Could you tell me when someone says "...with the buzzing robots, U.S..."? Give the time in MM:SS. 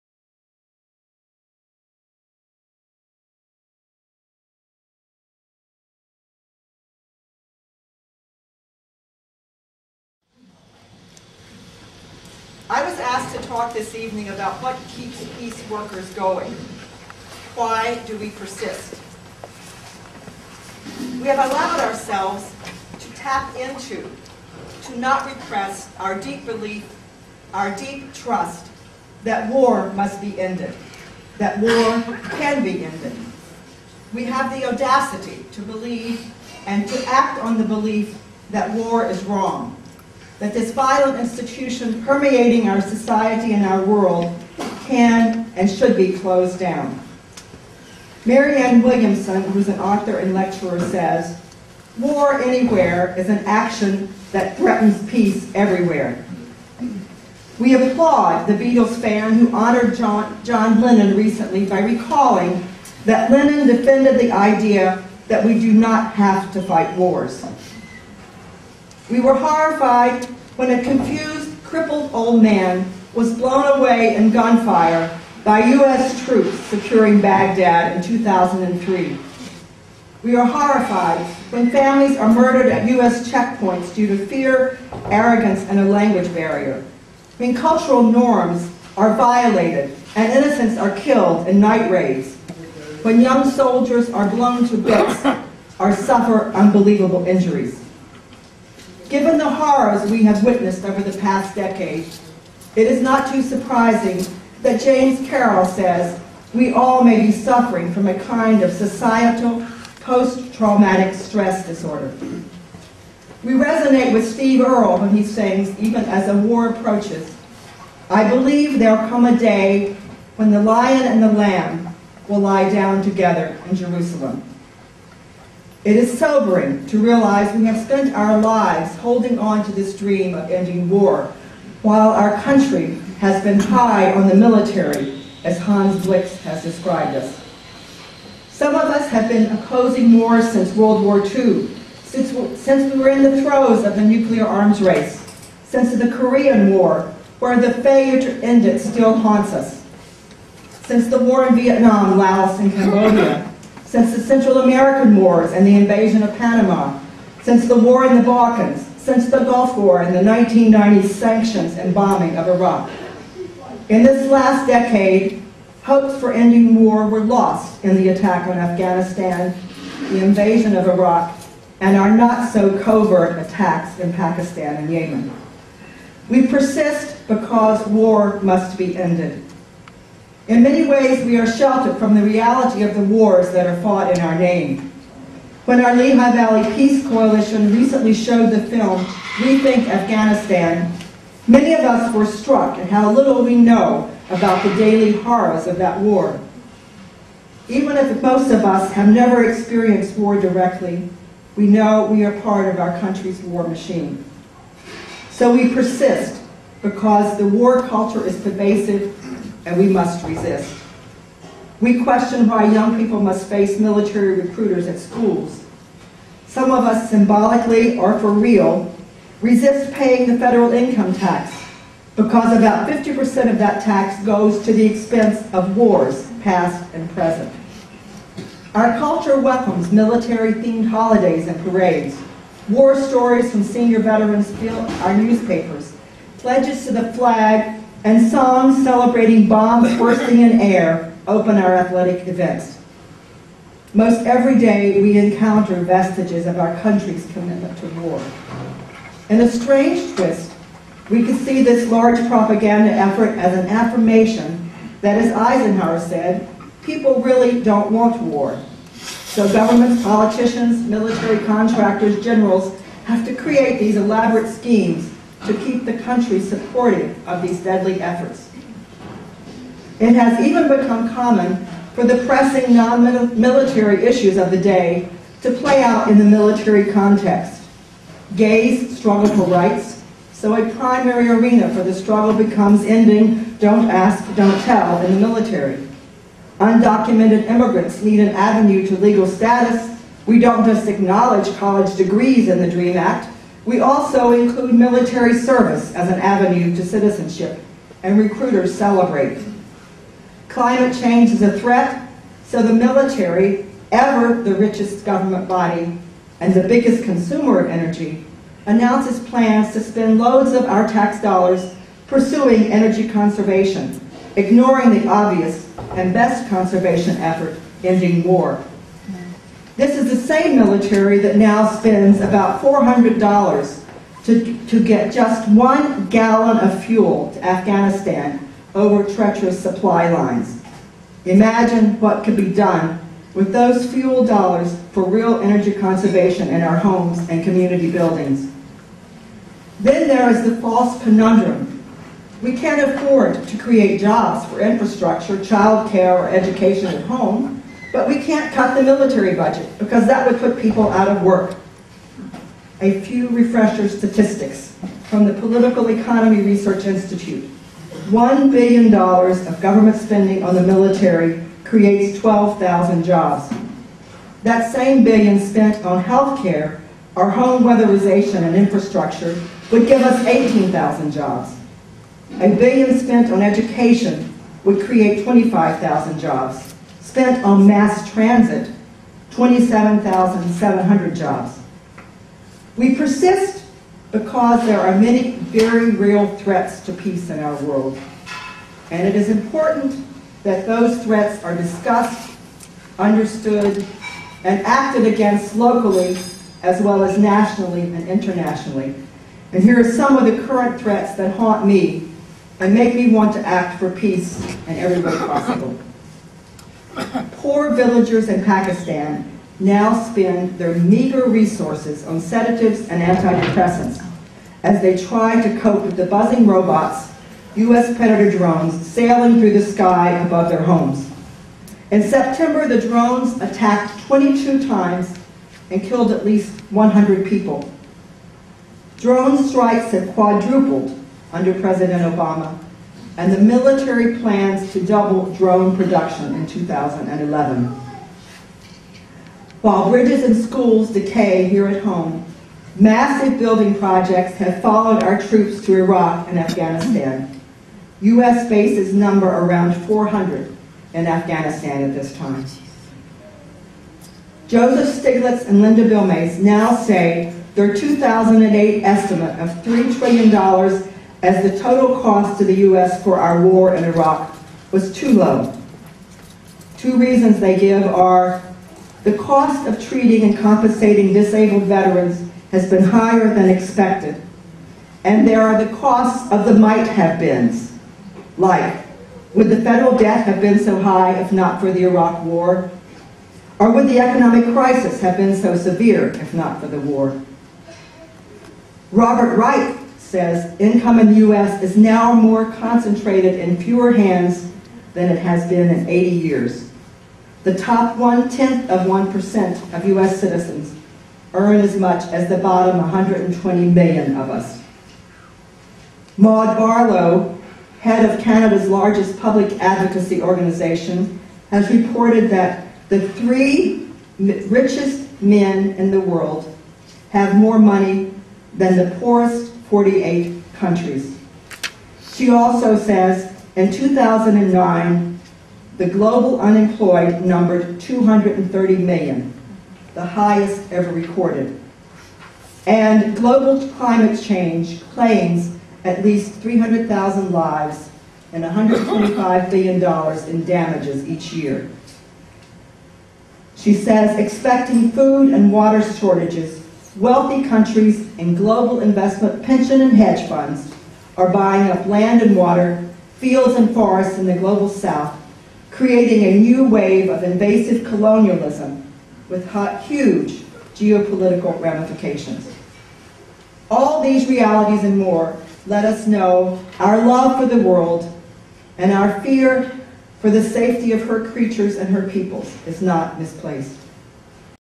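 06:55.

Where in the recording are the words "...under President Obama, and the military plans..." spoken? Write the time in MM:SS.
07:11.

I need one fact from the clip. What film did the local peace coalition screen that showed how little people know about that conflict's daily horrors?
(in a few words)
Rethink Afghanistan.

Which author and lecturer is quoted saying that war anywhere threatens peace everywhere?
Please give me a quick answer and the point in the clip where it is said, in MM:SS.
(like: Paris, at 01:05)
Marianne Williamson, at 00:48.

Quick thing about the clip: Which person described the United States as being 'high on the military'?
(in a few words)
Hans Blix.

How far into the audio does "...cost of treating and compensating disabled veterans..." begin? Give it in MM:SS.
07:49.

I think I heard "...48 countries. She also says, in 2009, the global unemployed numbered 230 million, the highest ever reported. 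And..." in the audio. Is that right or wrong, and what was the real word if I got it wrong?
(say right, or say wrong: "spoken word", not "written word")
wrong: "recorded", not "reported".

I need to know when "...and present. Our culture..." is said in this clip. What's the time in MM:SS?
03:46.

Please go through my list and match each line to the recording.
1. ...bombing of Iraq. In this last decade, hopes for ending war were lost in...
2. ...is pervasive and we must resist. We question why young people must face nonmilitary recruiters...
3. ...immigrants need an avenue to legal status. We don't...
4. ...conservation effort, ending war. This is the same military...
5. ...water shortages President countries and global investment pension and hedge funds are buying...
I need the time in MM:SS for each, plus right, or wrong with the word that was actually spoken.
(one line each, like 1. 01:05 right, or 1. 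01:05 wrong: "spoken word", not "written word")
1. 02:41 right
2. 03:28 wrong: "military", not "nonmilitary"
3. 04:47 right
4. 05:16 right
5. 09:05 wrong: "Wealthy", not "President".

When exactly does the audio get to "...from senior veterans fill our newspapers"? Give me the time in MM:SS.
03:53.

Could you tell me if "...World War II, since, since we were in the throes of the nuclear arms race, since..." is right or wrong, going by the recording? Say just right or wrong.
right.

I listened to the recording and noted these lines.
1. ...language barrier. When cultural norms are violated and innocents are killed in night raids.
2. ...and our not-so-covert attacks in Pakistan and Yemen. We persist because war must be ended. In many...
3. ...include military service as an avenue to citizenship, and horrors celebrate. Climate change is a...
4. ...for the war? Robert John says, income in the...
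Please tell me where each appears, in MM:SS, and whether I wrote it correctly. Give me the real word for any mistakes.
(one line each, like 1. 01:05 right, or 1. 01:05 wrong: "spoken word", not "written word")
1. 01:25 right
2. 02:51 right
3. 04:54 wrong: "recruiters", not "horrors"
4. 08:06 wrong: "Wright", not "John".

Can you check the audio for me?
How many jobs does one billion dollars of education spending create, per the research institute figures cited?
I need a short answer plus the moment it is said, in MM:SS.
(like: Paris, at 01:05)
25,000, at 06:15.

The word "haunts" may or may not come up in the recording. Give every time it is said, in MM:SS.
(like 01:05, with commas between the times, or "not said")
02:29, 06:41.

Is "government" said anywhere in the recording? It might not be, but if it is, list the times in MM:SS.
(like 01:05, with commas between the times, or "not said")
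04:19, 05:05, 05:59.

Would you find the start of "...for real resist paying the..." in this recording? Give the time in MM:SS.
03:38.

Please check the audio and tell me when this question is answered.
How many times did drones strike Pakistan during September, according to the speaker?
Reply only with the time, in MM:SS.
07:04.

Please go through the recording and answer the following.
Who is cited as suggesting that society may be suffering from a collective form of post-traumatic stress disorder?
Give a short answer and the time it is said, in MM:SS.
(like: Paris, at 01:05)
James Carroll, at 01:44.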